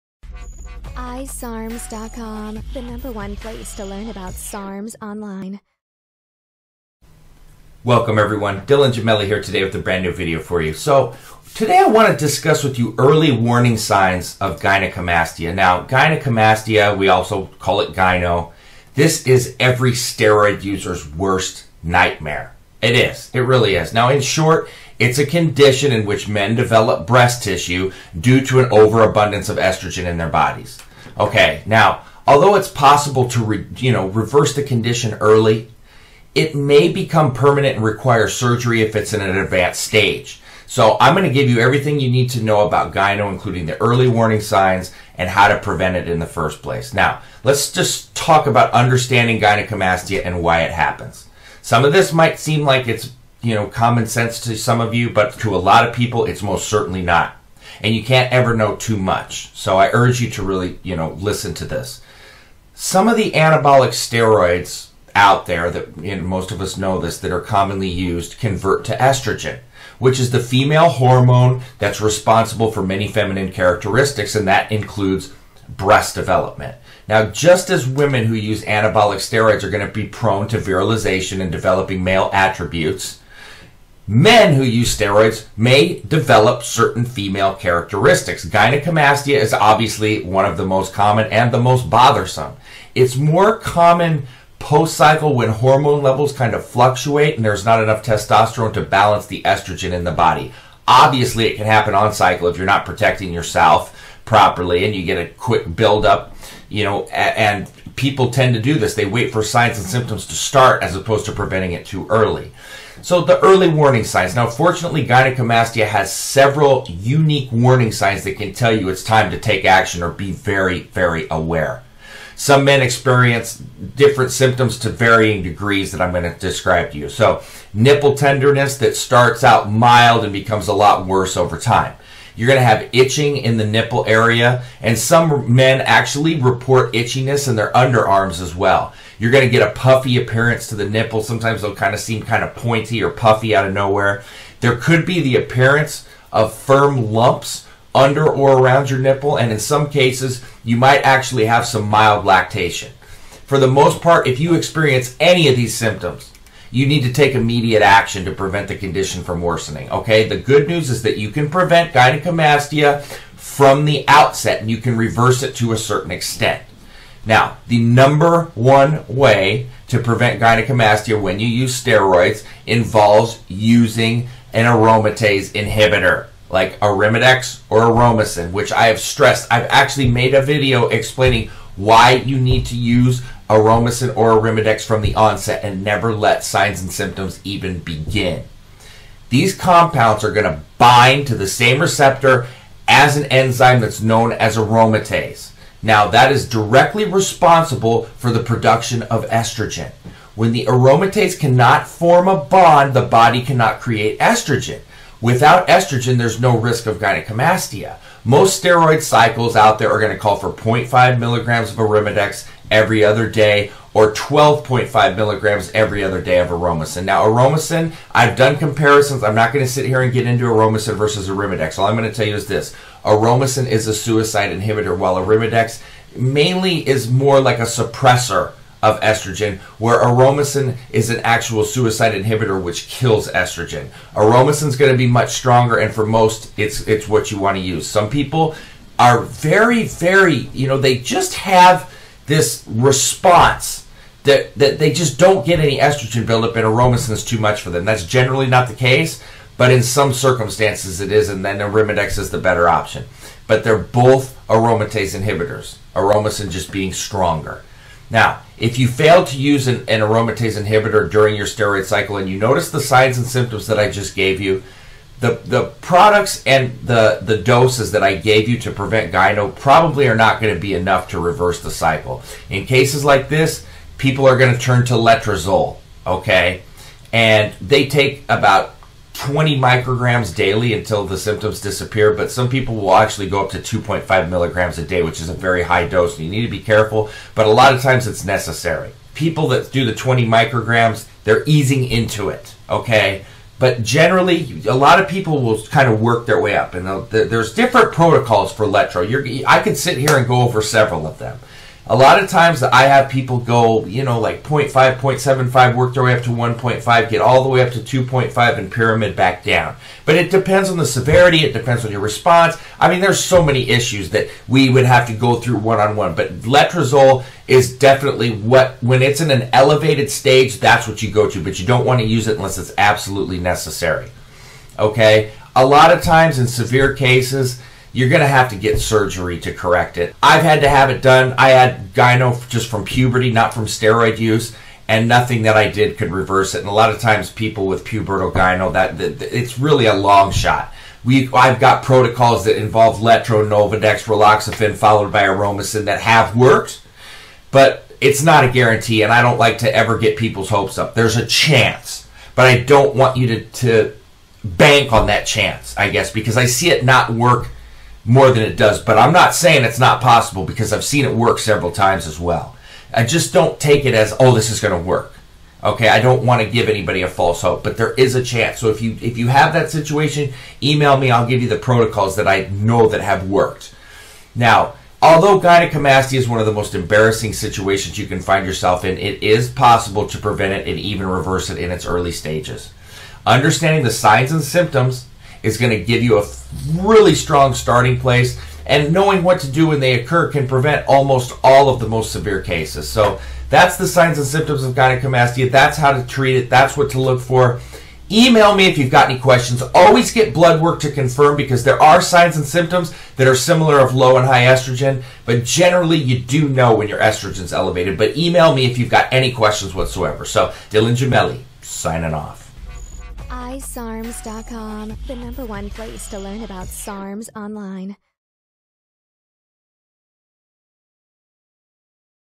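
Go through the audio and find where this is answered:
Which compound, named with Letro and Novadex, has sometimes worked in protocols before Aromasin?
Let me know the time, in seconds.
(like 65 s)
344 s.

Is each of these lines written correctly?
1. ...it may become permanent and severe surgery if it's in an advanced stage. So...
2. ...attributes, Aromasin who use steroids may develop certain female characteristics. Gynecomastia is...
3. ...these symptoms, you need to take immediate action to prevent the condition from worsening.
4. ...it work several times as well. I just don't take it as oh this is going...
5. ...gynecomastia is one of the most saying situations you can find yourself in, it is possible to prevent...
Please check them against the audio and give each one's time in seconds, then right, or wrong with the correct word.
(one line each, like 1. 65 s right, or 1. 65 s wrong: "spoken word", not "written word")
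1. 36 s wrong: "require", not "severe"
2. 82 s wrong: "Men", not "Aromasin"
3. 155 s right
4. 361 s right
5. 375 s wrong: "embarrassing", not "saying".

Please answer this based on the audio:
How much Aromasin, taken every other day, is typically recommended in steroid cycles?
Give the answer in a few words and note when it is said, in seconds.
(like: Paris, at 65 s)
12.5 milligrams, at 214 s.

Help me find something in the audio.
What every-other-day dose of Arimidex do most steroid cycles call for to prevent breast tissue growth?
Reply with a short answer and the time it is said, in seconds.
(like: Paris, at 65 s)
0.5 milligrams, at 210 s.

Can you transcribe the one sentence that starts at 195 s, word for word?
Now, that is directly responsible for the production of estrogen.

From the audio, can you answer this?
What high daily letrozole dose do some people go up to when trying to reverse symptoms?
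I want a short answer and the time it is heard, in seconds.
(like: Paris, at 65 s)
2.5 milligrams, at 283 s.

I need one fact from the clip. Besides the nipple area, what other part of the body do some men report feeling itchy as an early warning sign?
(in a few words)
Underarms.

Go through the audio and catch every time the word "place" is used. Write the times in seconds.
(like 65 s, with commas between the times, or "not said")
3 s, 46 s, 387 s, 415 s.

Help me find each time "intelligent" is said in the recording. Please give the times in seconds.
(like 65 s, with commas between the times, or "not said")
not said.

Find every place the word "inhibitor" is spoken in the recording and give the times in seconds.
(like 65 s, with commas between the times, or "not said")
175 s, 224 s, 232 s, 255 s, 260 s.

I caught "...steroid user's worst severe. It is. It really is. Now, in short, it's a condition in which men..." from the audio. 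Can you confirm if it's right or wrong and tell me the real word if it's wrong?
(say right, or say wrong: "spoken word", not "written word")
wrong: "nightmare", not "severe".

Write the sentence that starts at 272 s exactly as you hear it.
In cases like this, people are going to turn to letrozole, okay?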